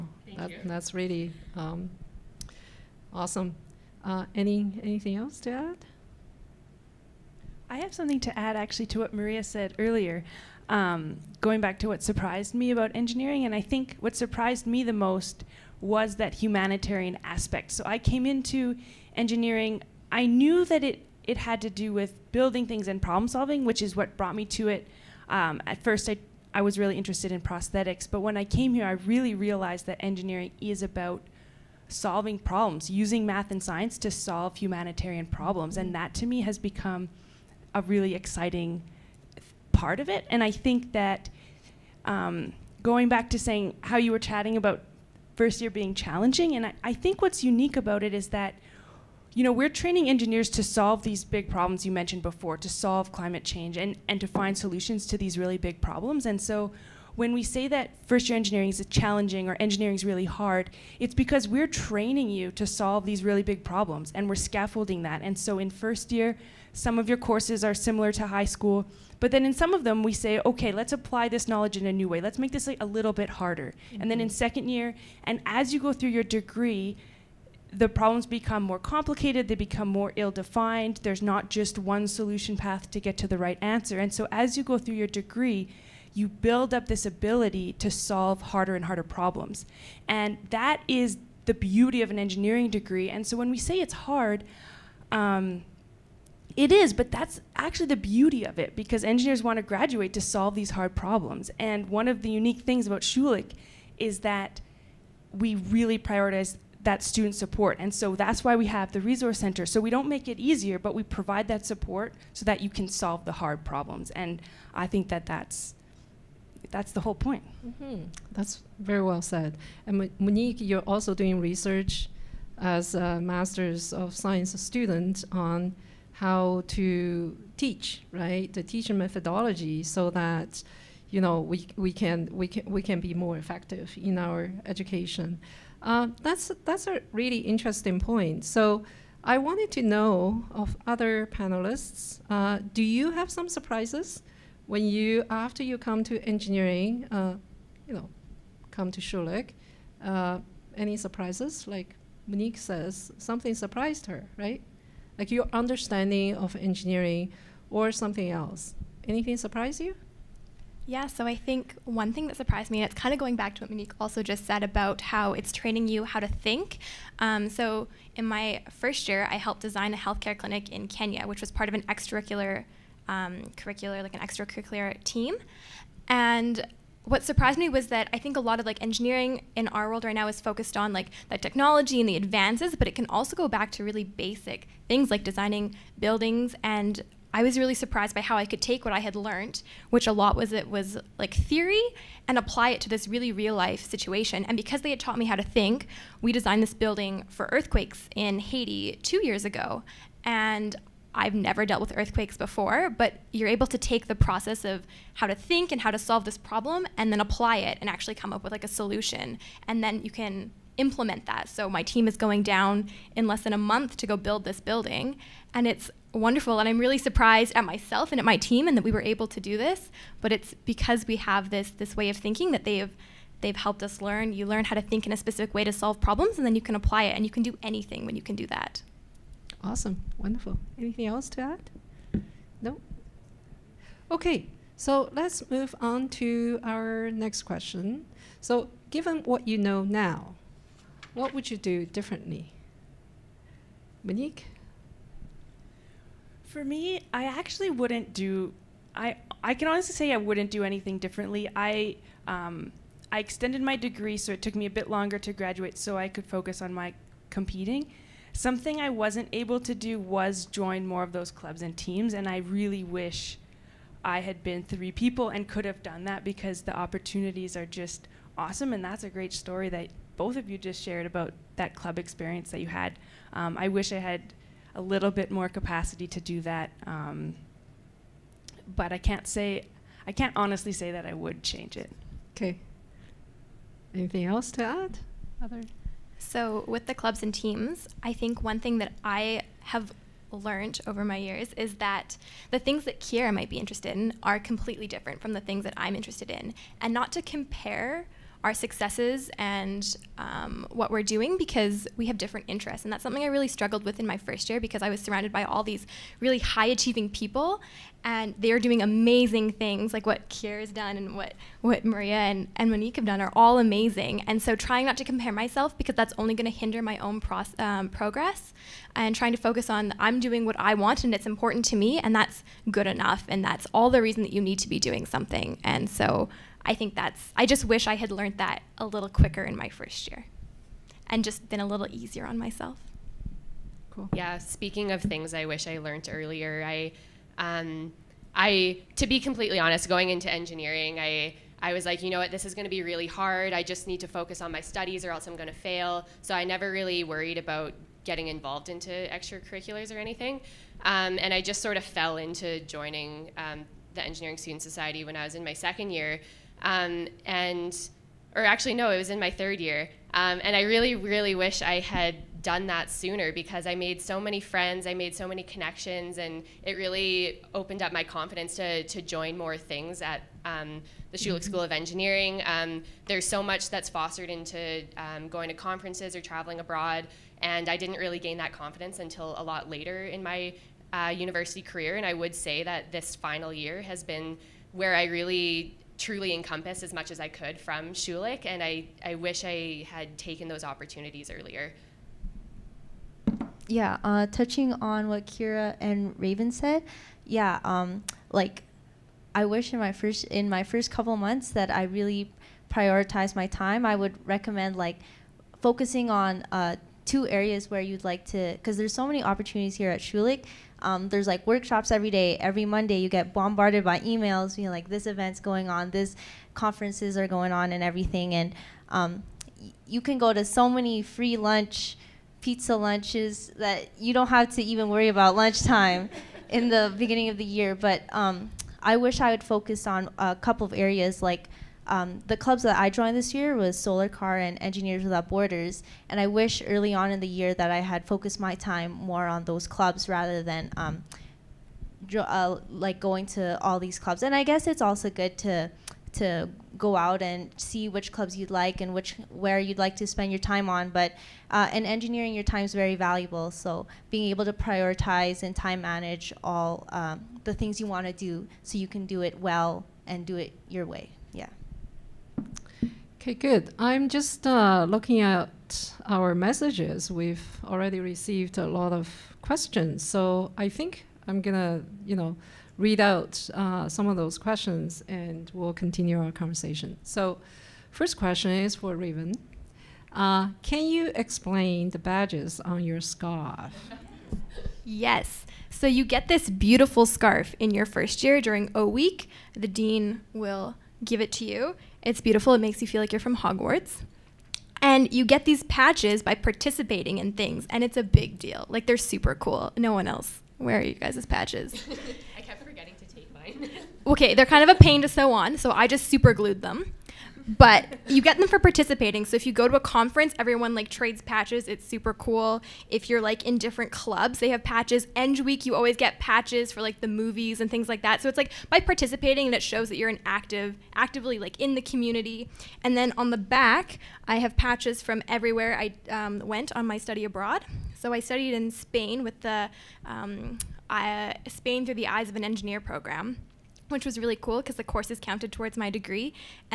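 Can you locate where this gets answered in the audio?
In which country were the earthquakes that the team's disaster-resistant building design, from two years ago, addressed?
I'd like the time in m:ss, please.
3:18.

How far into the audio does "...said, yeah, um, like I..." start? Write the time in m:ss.
6:36.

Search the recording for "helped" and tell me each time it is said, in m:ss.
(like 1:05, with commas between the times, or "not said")
2:49, 3:43.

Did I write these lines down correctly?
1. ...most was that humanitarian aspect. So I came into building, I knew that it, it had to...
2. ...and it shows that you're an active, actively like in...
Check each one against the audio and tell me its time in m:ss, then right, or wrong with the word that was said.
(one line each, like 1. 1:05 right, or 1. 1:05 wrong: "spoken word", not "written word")
1. 0:14 wrong: "engineering", not "building"
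2. 8:39 right.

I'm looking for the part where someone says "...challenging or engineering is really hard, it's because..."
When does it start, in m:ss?
0:58.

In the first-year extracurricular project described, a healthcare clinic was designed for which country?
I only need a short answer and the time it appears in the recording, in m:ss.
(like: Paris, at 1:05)
Kenya, at 2:50.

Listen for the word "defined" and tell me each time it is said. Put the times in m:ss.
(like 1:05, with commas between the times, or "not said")
1:20.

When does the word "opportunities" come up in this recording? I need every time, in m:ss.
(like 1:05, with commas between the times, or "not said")
4:26, 6:30, 6:49.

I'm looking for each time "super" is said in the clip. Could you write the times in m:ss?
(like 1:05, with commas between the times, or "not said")
8:18, 8:26, 8:31.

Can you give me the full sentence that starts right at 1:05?
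And so in first year, some of your courses are similar to high school.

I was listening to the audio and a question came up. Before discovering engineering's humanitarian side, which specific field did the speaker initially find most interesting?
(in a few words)
prosthetics.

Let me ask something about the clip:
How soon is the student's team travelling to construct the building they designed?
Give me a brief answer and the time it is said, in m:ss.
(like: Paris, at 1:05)
less than a month, at 3:33.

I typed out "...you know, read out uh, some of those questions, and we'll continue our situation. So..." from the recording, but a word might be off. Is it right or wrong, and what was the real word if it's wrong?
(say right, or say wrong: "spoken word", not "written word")
wrong: "conversation", not "situation".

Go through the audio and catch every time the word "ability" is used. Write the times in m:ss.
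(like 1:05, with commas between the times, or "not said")
1:27.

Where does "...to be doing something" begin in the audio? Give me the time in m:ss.
5:24.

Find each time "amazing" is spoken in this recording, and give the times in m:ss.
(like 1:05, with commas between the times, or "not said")
5:08, 5:13.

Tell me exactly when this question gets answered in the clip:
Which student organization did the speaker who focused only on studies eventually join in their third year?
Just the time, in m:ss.
5:54.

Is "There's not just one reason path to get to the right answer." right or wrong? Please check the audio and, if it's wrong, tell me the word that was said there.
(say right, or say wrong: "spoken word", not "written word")
wrong: "solution", not "reason".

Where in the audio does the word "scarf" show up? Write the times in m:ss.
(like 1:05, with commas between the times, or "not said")
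8:03, 8:07.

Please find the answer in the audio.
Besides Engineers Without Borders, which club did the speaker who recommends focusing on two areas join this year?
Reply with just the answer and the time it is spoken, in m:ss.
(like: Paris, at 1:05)
Solar Car, at 7:13.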